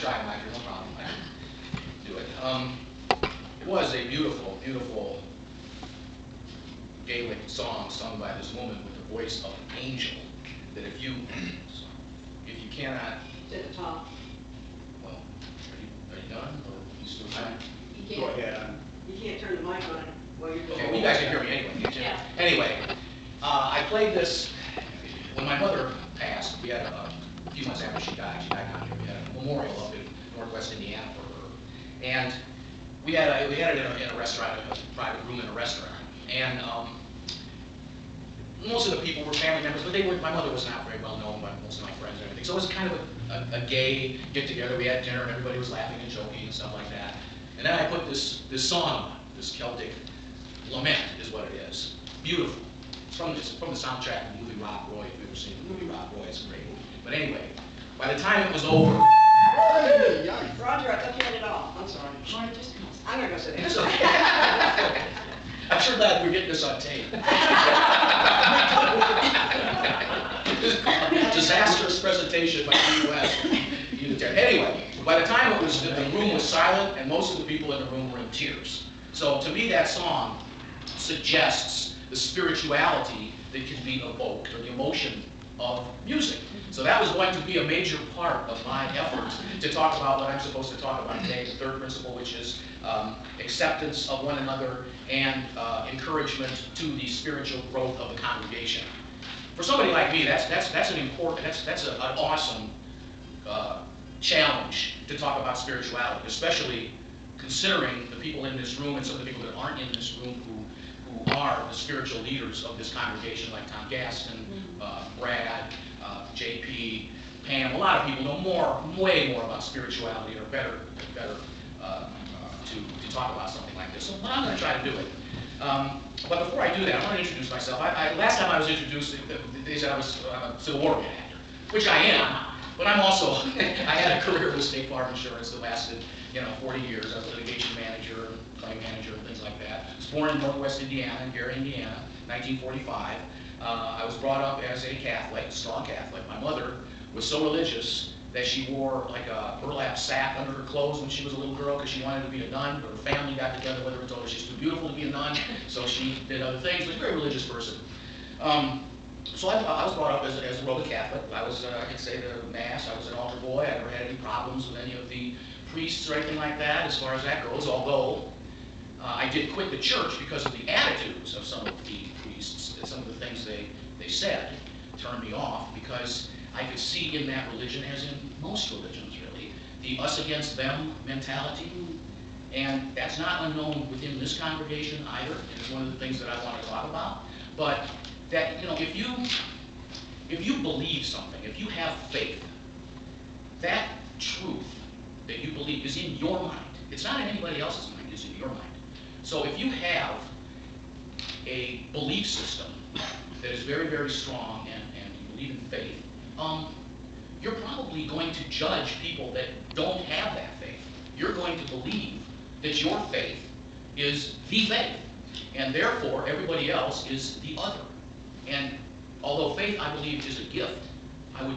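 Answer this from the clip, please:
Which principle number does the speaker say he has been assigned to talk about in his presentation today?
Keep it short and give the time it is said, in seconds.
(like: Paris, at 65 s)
third, at 91 s.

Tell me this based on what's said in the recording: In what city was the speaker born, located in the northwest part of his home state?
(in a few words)
Gary, Indiana.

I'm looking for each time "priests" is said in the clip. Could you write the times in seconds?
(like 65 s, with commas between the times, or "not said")
165 s, 172 s.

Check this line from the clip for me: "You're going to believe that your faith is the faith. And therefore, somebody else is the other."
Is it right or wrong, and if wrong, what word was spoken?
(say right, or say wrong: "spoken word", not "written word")
wrong: "everybody", not "somebody".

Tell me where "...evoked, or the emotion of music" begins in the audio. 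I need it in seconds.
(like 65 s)
84 s.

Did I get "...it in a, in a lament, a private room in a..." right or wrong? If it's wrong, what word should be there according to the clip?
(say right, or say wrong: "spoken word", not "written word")
wrong: "restaurant", not "lament".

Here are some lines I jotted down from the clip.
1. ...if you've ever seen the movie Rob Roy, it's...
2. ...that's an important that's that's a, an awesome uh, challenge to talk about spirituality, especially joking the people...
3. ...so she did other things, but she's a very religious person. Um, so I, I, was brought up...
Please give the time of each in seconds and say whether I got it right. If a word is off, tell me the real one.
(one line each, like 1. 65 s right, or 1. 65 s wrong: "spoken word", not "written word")
1. 55 s right
2. 100 s wrong: "considering", not "joking"
3. 155 s right.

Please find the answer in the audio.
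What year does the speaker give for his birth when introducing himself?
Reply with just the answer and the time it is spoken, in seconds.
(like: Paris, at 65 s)
1945, at 142 s.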